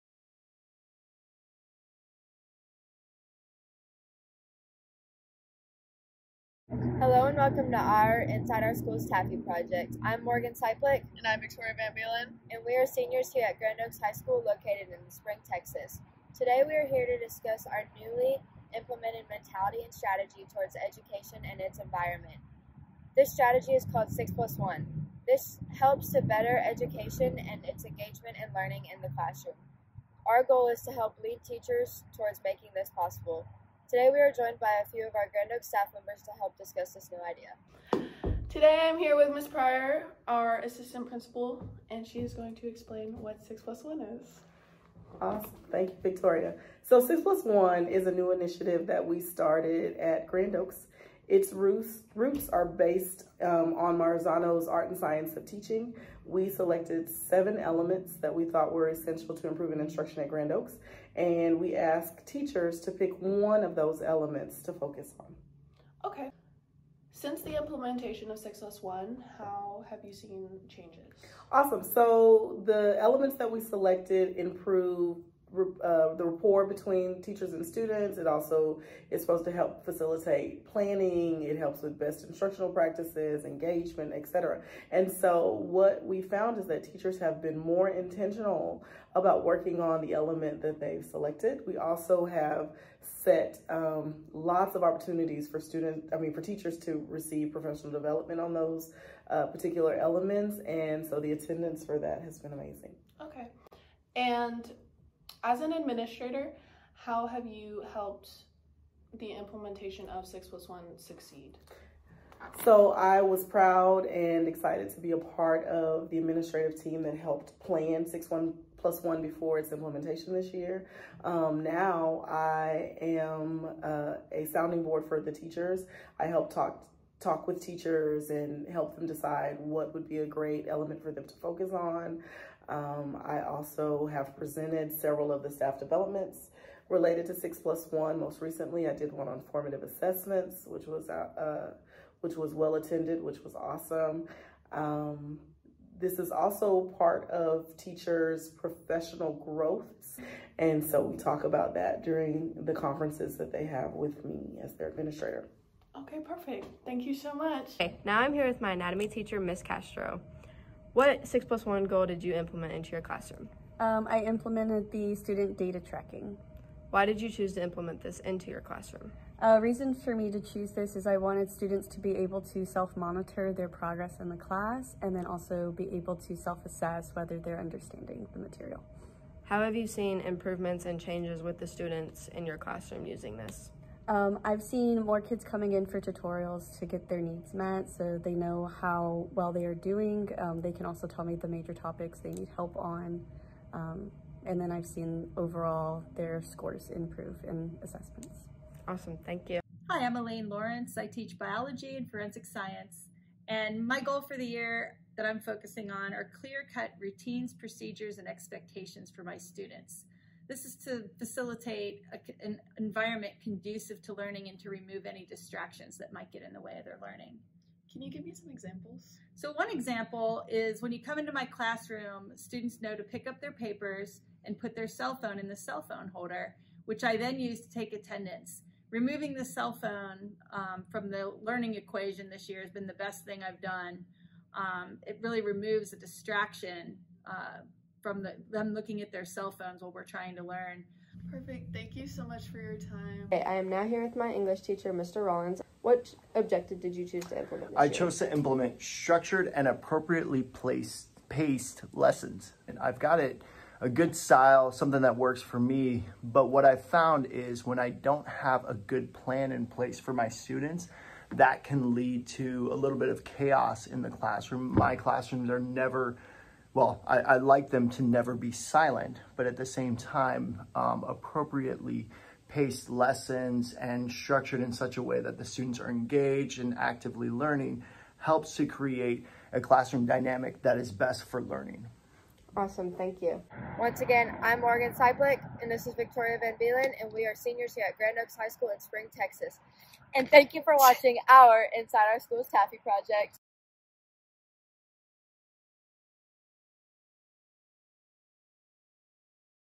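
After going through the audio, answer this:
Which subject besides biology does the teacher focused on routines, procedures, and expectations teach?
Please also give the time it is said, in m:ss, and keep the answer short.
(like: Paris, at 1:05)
forensic science, at 3:22.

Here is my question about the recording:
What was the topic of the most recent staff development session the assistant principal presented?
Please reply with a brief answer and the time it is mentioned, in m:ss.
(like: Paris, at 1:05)
formative assessments, at 2:19.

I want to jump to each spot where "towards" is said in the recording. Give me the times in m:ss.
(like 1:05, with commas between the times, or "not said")
0:20, 0:32.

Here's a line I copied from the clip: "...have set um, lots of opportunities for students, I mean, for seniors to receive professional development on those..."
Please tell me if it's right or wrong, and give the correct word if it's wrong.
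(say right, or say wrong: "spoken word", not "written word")
wrong: "teachers", not "seniors".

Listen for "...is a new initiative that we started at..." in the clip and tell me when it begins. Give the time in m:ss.
0:47.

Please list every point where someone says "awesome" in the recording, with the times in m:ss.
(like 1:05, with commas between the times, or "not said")
0:45, 1:11, 2:23, 3:18, 4:42.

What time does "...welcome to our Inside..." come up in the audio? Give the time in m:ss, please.
0:07.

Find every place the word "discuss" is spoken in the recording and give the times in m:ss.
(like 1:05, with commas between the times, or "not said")
0:17, 0:36.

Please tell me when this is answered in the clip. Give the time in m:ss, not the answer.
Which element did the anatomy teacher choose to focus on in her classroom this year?
2:45.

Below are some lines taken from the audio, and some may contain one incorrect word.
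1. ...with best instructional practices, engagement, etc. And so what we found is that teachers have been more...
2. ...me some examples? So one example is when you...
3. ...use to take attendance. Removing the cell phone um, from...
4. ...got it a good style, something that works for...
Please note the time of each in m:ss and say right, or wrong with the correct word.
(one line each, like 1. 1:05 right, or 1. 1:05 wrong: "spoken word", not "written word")
1. 1:21 right
2. 3:38 right
3. 3:47 right
4. 4:12 right.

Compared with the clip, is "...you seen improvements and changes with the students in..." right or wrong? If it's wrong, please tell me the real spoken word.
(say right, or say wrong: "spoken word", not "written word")
right.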